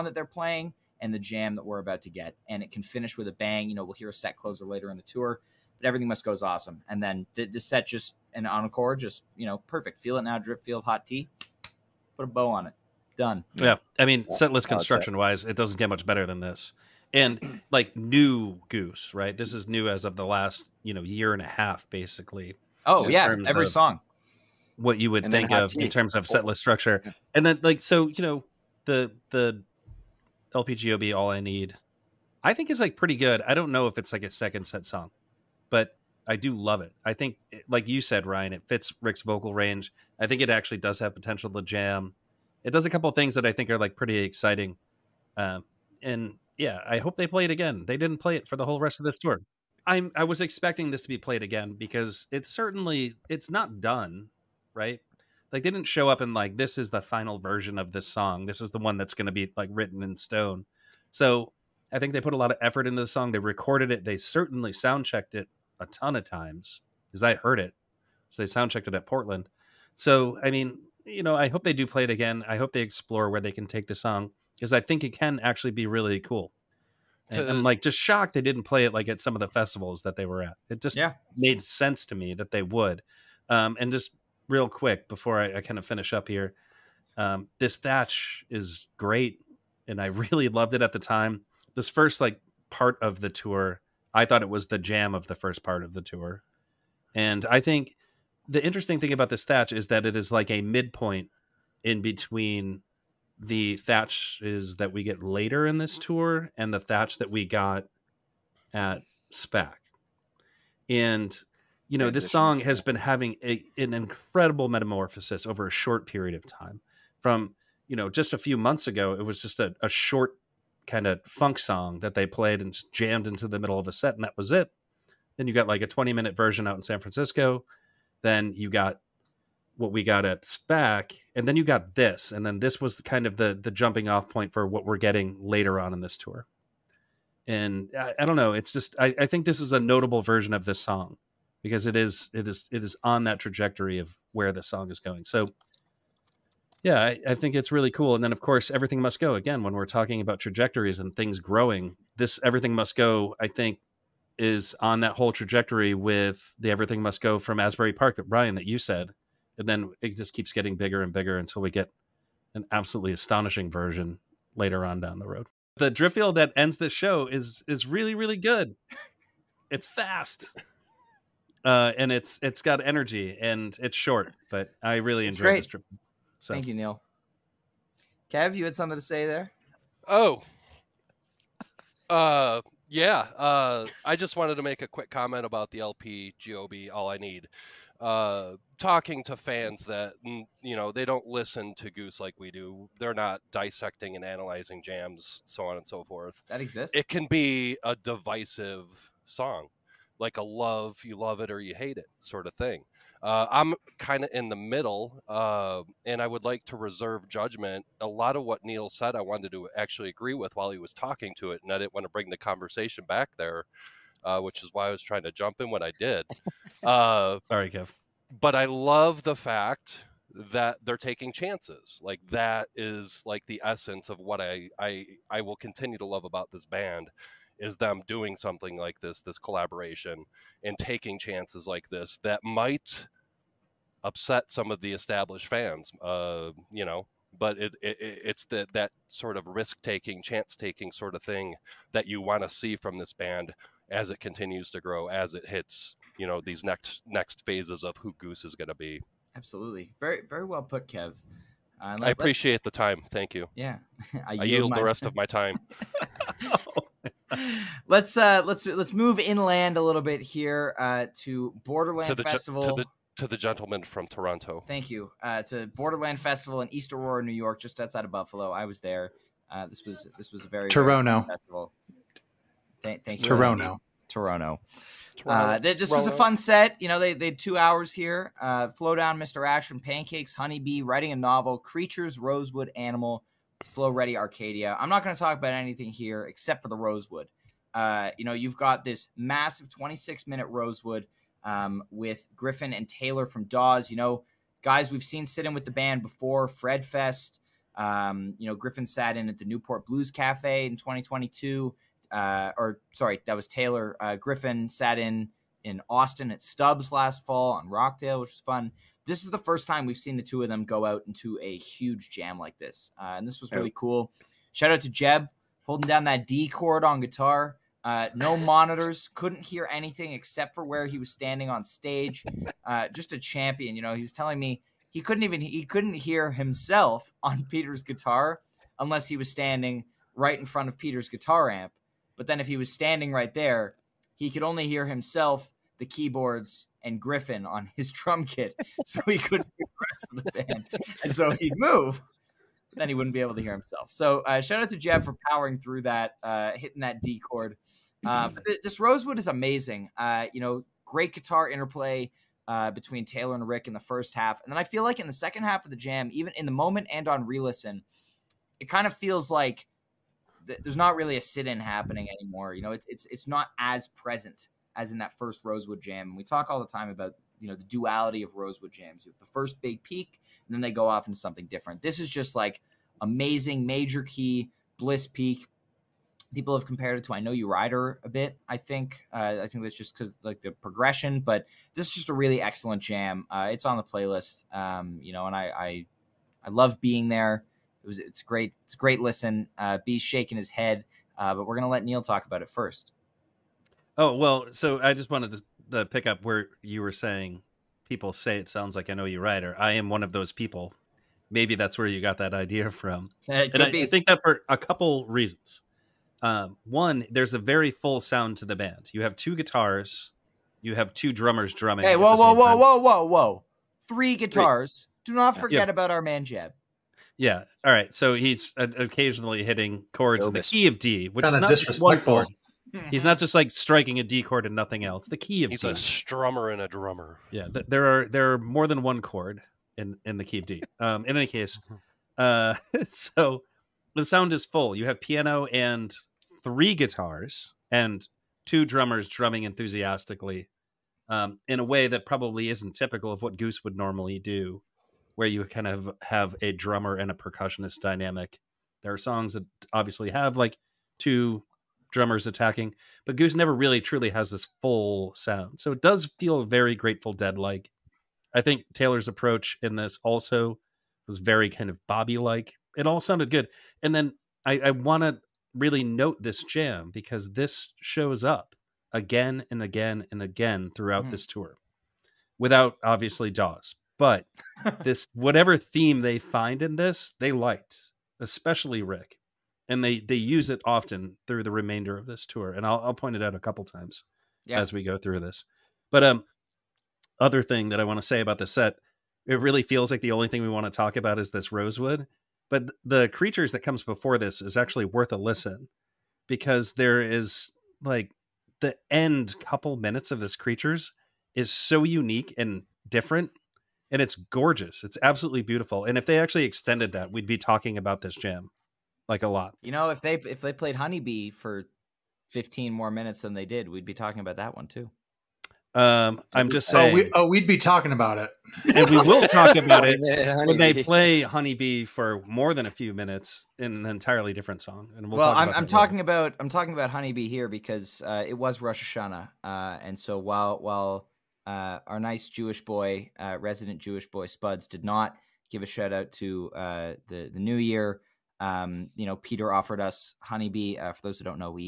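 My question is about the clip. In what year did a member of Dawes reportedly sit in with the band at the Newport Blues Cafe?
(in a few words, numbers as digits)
2022.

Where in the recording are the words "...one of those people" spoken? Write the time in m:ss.
6:39.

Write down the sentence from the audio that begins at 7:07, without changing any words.
Yeah, th- there are there are more than one chord in in the key of D.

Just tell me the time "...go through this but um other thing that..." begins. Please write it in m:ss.
8:04.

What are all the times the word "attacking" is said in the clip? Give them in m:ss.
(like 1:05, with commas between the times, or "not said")
7:32.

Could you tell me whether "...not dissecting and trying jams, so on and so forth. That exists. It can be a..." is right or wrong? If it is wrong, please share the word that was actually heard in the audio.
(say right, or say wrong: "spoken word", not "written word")
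wrong: "analyzing", not "trying".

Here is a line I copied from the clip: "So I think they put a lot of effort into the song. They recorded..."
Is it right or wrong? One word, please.
right.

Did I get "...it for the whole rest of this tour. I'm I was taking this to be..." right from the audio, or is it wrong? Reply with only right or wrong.
wrong.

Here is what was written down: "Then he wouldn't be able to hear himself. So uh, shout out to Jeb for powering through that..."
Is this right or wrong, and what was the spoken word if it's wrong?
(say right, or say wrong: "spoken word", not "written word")
right.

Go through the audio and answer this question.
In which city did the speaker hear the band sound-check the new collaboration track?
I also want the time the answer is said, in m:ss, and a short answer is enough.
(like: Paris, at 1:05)
Portland, at 1:09.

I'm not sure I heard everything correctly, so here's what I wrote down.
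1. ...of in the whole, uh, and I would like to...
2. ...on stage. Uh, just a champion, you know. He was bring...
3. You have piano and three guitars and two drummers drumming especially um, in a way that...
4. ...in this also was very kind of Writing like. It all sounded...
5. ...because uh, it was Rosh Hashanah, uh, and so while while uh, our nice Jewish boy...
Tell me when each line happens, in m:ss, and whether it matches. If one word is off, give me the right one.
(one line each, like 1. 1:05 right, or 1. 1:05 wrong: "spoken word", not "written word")
1. 3:24 wrong: "middle", not "whole"
2. 5:21 wrong: "telling", not "bring"
3. 7:14 wrong: "enthusiastically", not "especially"
4. 7:39 wrong: "Bobby", not "Writing"
5. 8:47 right.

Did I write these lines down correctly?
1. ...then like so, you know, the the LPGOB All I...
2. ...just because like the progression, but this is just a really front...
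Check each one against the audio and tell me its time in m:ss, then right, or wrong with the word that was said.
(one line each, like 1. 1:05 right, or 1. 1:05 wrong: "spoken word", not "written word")
1. 0:27 right
2. 6:19 wrong: "excellent", not "front".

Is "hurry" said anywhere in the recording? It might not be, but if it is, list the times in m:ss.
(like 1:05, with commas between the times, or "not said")
not said.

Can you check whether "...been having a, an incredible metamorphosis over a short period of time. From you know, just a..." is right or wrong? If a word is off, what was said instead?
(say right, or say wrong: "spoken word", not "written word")
right.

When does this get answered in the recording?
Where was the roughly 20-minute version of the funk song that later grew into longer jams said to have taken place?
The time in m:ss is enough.
2:06.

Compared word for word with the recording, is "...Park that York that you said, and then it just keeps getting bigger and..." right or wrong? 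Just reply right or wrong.
wrong.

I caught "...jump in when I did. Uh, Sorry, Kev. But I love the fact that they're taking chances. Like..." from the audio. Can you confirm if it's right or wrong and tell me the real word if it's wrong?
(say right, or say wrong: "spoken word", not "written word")
right.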